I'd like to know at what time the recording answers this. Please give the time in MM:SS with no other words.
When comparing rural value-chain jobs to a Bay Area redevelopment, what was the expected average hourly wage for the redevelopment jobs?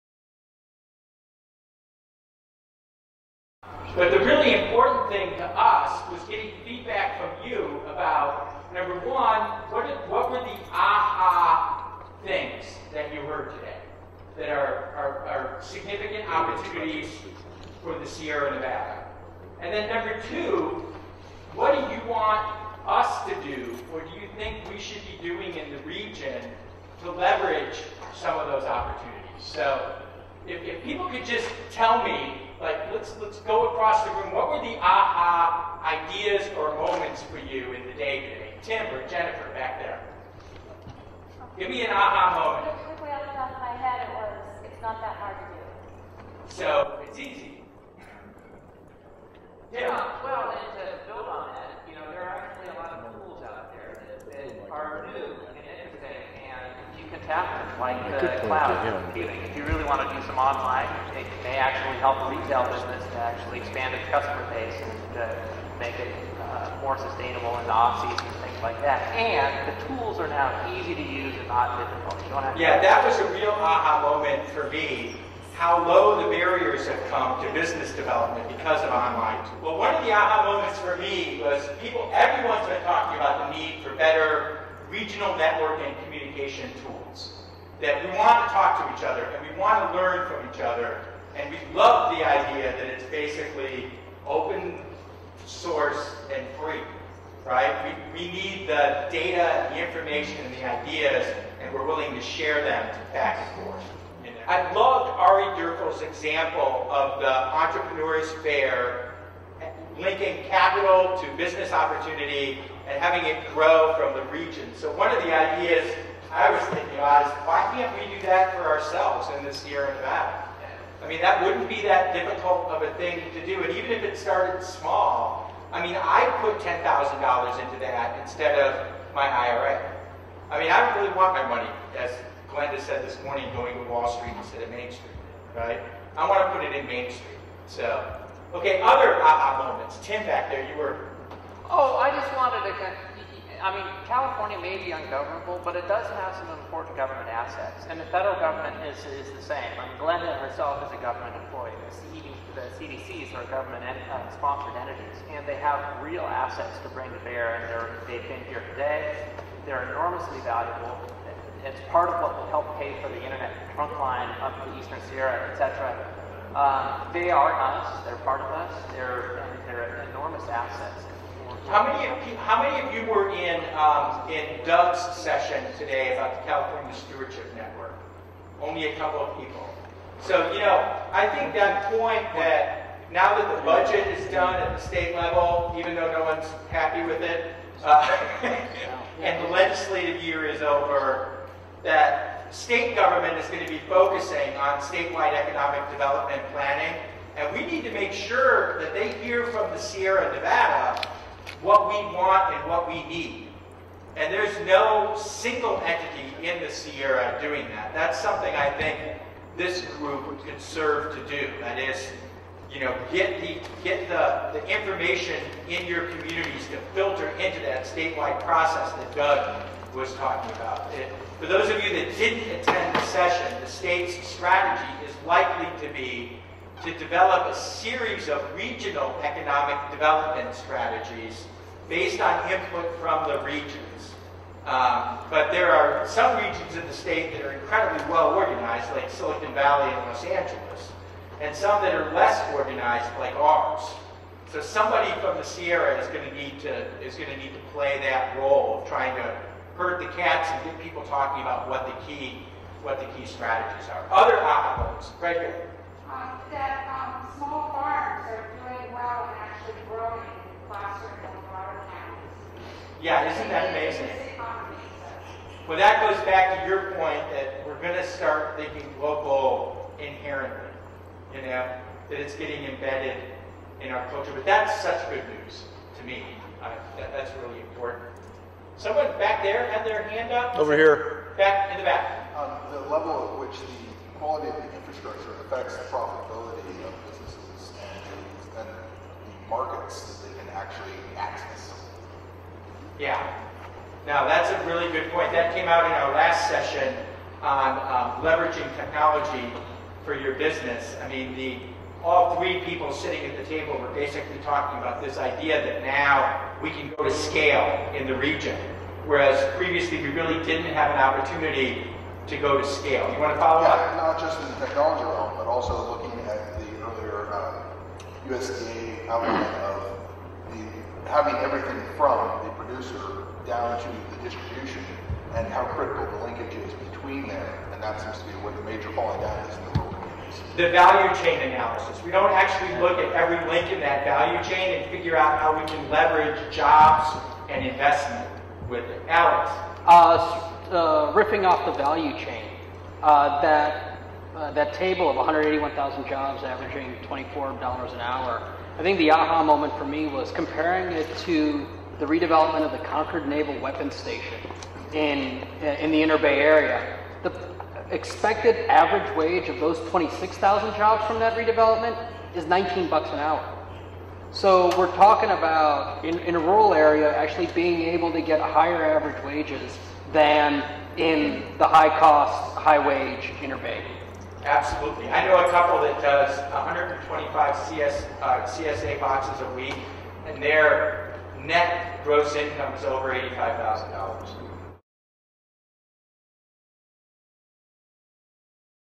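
06:02.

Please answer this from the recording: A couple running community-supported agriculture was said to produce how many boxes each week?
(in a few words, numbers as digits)
125.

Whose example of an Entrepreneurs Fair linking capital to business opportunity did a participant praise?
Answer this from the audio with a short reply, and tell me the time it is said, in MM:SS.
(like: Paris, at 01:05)
Ari Durkel, at 01:45.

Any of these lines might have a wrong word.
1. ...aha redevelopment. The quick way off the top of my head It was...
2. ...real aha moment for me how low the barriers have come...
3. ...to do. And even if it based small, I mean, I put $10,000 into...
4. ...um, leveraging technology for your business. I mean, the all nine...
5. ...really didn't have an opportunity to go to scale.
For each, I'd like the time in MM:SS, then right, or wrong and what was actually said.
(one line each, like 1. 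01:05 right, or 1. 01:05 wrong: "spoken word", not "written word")
1. 00:41 wrong: "moment", not "redevelopment"
2. 01:13 right
3. 02:03 wrong: "started", not "based"
4. 04:57 wrong: "three", not "nine"
5. 05:10 right.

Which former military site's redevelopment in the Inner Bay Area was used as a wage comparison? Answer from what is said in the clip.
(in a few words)
Concord Naval Weapons Station.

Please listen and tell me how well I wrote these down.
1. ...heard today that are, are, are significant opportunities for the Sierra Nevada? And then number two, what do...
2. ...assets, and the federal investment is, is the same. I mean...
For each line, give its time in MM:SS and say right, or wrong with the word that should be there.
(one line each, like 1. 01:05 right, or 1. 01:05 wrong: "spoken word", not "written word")
1. 00:13 right
2. 02:27 wrong: "government", not "investment".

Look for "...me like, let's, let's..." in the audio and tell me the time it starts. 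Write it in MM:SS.
00:32.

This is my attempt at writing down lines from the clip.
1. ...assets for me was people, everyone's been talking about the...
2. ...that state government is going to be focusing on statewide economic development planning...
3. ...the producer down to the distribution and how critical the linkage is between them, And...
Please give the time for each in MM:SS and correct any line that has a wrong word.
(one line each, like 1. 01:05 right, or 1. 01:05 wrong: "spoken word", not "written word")
1. 01:20 wrong: "moments", not "assets"
2. 03:11 right
3. 05:22 right.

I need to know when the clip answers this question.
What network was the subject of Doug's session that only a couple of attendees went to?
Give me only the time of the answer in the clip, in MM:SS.
02:56.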